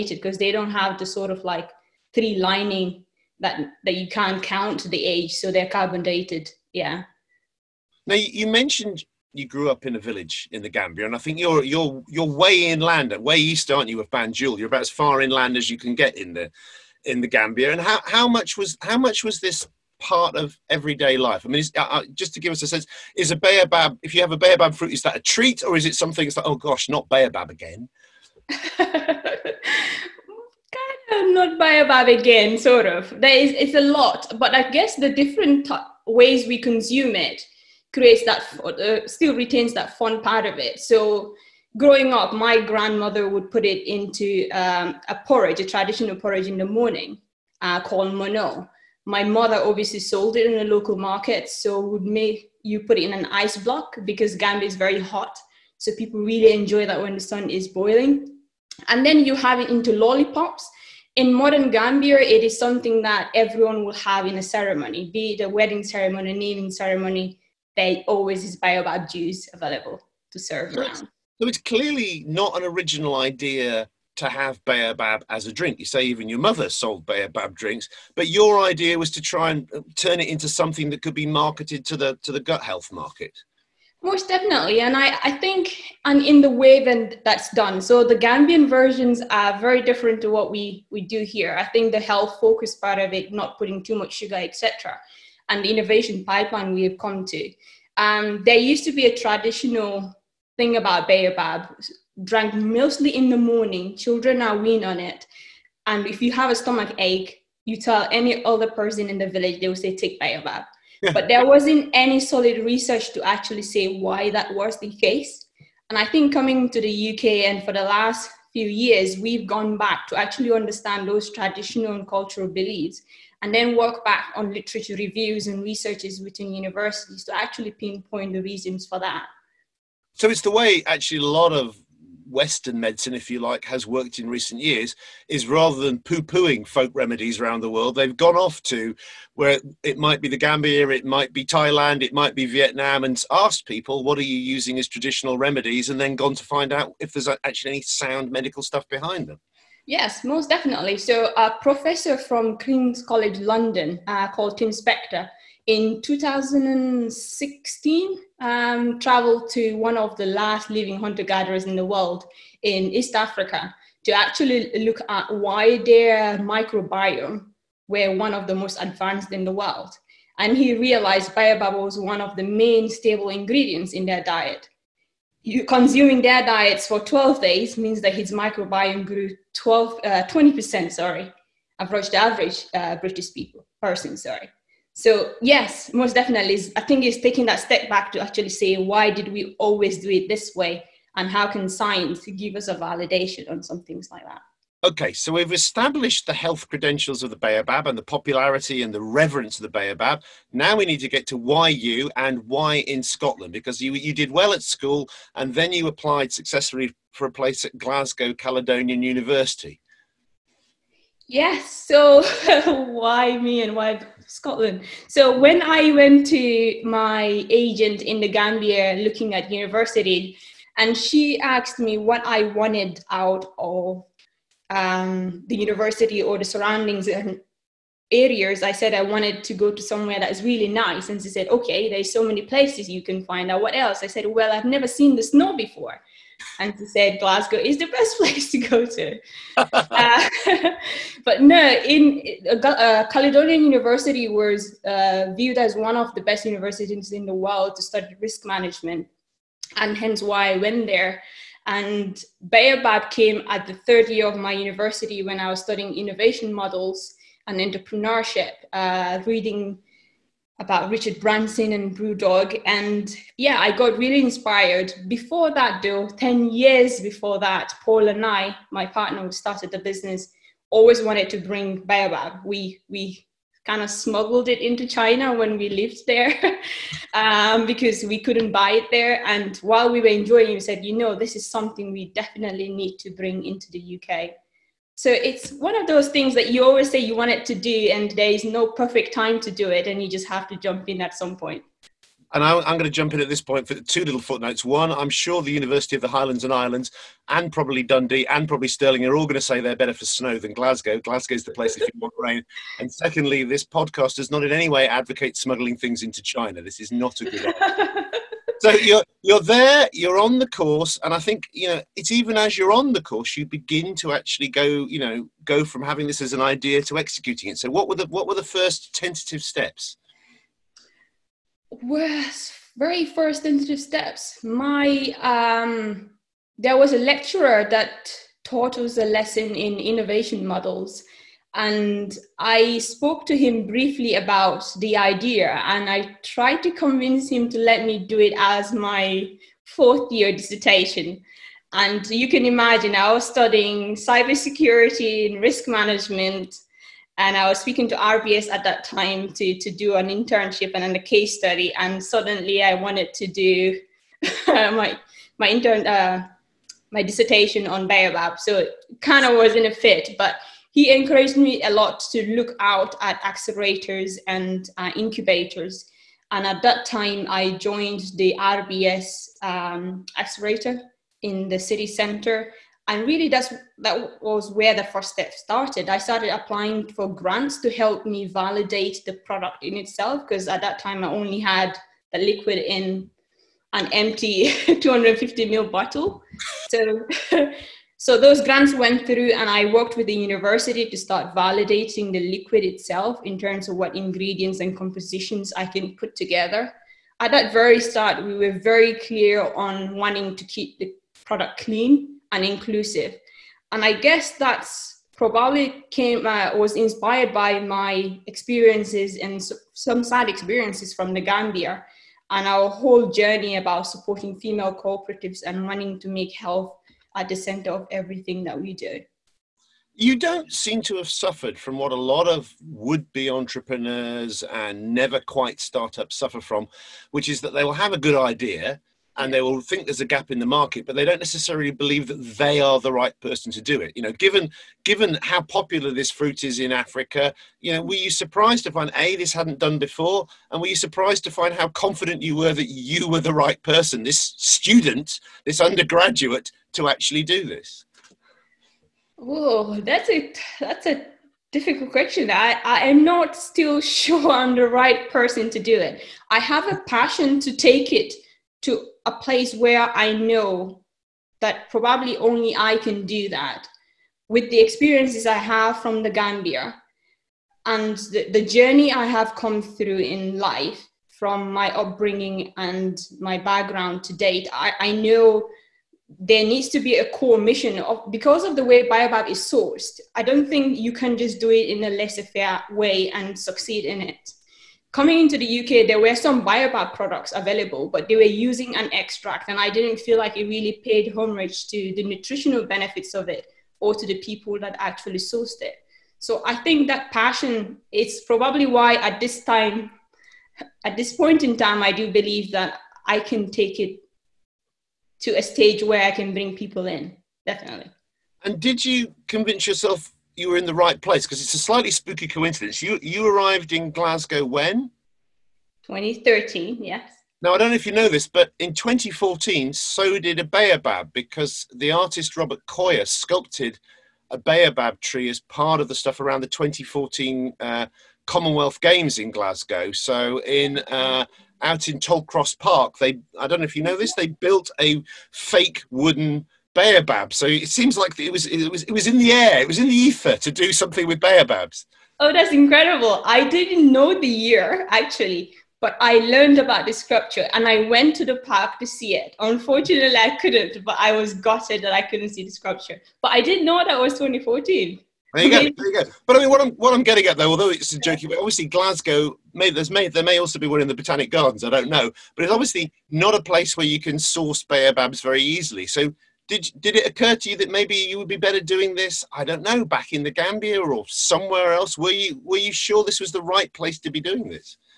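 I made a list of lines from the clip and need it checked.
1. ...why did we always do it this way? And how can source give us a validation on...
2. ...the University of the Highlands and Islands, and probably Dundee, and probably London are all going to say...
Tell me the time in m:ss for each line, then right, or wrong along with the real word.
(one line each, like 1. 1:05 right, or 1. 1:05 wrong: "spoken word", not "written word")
1. 3:08 wrong: "science", not "source"
2. 4:55 wrong: "Stirling", not "London".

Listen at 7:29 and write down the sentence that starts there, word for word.
Oh, that's a that's a difficult question.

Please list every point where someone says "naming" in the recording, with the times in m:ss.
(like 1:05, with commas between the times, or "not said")
1:06.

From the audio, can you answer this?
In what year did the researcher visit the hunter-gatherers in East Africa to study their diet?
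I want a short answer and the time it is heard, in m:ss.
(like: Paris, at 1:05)
2016, at 2:36.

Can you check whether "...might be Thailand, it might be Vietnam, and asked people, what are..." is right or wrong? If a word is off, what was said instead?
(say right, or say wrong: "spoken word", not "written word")
right.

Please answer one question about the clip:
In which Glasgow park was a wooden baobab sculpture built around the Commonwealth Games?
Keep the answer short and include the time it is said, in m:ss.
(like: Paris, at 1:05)
Tollcross Park, at 8:51.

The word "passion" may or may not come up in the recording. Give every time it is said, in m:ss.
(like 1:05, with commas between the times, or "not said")
7:36, 8:17.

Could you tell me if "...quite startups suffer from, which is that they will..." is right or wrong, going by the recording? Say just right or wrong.
right.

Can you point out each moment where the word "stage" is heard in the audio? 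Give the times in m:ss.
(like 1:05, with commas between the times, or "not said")
8:25.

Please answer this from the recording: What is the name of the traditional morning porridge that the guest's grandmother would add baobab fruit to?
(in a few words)
mono.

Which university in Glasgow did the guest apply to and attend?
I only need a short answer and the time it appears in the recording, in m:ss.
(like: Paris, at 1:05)
Glasgow Caledonian University, at 3:27.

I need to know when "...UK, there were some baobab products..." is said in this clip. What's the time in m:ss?
8:05.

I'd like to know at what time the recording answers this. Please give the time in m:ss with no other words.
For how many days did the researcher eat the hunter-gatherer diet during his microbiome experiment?
2:56.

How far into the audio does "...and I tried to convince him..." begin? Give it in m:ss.
5:35.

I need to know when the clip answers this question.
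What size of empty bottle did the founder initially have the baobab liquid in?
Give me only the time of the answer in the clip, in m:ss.
6:24.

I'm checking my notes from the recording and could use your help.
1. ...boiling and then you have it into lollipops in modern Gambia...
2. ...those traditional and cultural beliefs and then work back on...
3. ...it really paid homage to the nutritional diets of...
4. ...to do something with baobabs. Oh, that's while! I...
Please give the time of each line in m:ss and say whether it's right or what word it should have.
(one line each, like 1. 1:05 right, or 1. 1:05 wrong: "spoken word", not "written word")
1. 0:57 right
2. 2:01 right
3. 8:10 wrong: "benefits", not "diets"
4. 9:00 wrong: "incredible", not "while".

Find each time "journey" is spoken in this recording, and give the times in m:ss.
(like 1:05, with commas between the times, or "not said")
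6:53, 7:48.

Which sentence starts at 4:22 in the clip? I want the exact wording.
And yeah, I got really inspired.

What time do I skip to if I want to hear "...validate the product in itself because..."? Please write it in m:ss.
6:18.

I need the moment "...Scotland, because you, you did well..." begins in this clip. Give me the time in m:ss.
3:23.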